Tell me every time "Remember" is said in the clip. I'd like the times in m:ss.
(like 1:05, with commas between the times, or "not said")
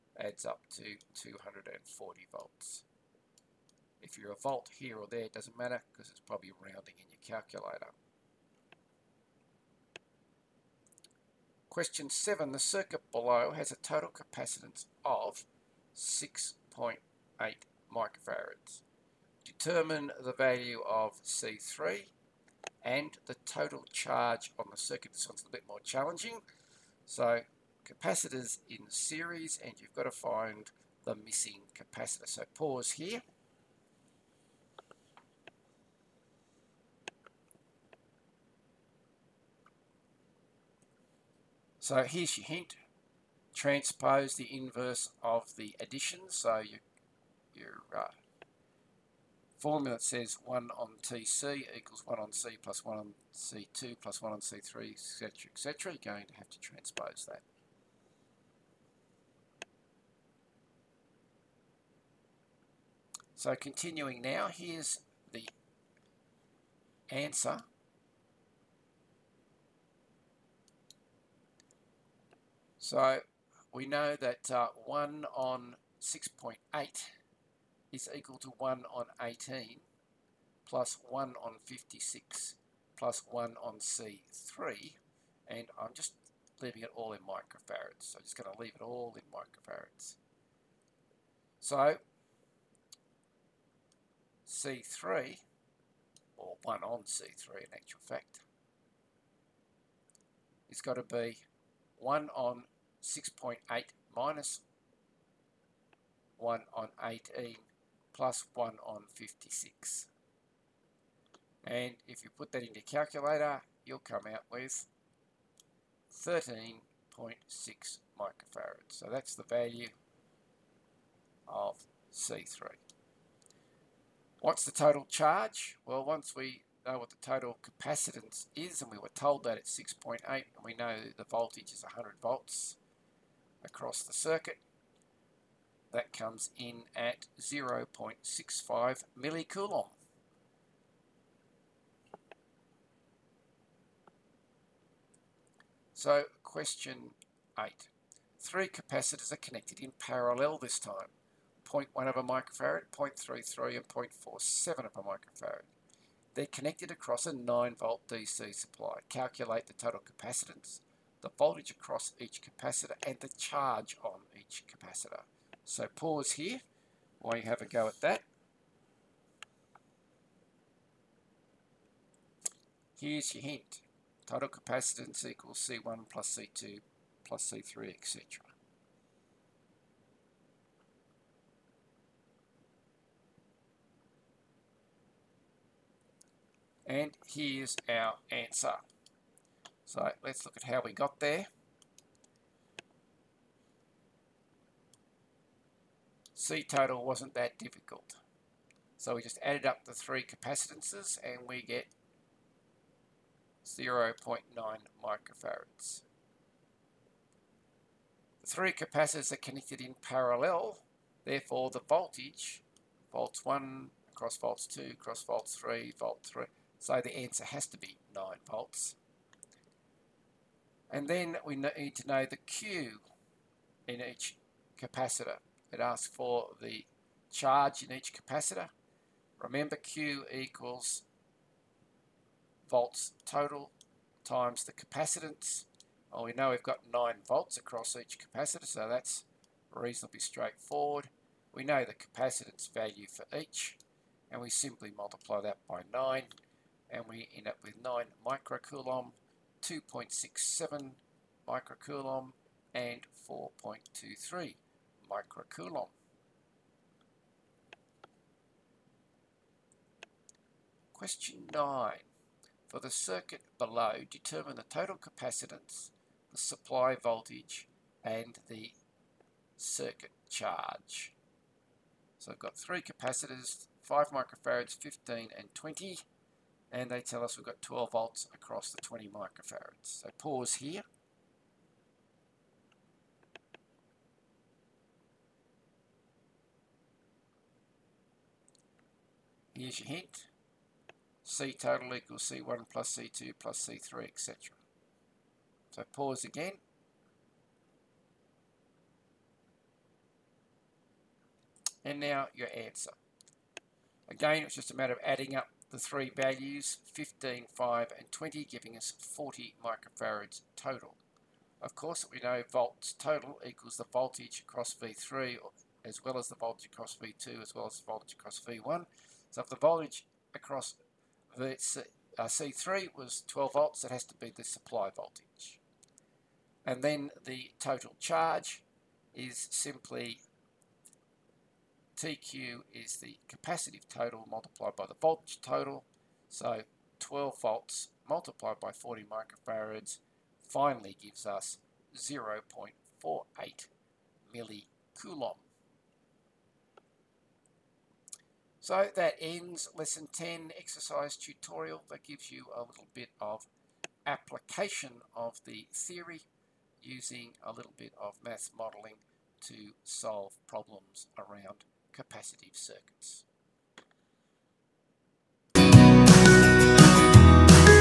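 3:49.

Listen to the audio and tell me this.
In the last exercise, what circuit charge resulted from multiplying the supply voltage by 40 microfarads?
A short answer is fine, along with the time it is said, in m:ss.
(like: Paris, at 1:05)
0.48 millicoulomb, at 5:41.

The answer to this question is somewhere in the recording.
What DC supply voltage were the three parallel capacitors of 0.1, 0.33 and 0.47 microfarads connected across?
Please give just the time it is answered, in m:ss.
2:37.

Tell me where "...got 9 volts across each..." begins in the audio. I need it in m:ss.
3:56.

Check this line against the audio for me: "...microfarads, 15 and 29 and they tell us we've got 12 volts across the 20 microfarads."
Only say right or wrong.
wrong.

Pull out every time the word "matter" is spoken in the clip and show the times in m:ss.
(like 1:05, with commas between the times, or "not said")
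0:05, 5:04.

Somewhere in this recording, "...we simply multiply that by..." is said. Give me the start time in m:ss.
4:04.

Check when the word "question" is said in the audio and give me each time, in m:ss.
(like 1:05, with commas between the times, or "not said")
0:11, 2:26, 4:20.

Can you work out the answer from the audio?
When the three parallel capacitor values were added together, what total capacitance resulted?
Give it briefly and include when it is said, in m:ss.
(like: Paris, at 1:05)
0.9 microfarads, at 3:23.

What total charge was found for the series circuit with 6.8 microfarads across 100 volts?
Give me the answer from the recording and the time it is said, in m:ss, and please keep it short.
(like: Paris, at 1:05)
0.65 millicoulomb, at 2:17.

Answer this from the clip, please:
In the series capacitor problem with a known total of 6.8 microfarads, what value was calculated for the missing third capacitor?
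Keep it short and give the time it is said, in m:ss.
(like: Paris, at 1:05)
13.6 microfarads, at 1:56.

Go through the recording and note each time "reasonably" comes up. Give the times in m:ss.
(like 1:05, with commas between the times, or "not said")
3:59.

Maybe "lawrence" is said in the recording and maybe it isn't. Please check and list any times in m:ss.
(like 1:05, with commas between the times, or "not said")
not said.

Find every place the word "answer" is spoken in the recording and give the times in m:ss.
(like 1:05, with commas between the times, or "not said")
1:07, 3:08, 3:37, 5:02.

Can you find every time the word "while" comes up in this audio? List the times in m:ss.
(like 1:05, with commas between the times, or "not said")
2:47.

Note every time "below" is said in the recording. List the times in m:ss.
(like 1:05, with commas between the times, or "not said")
0:13, 4:23.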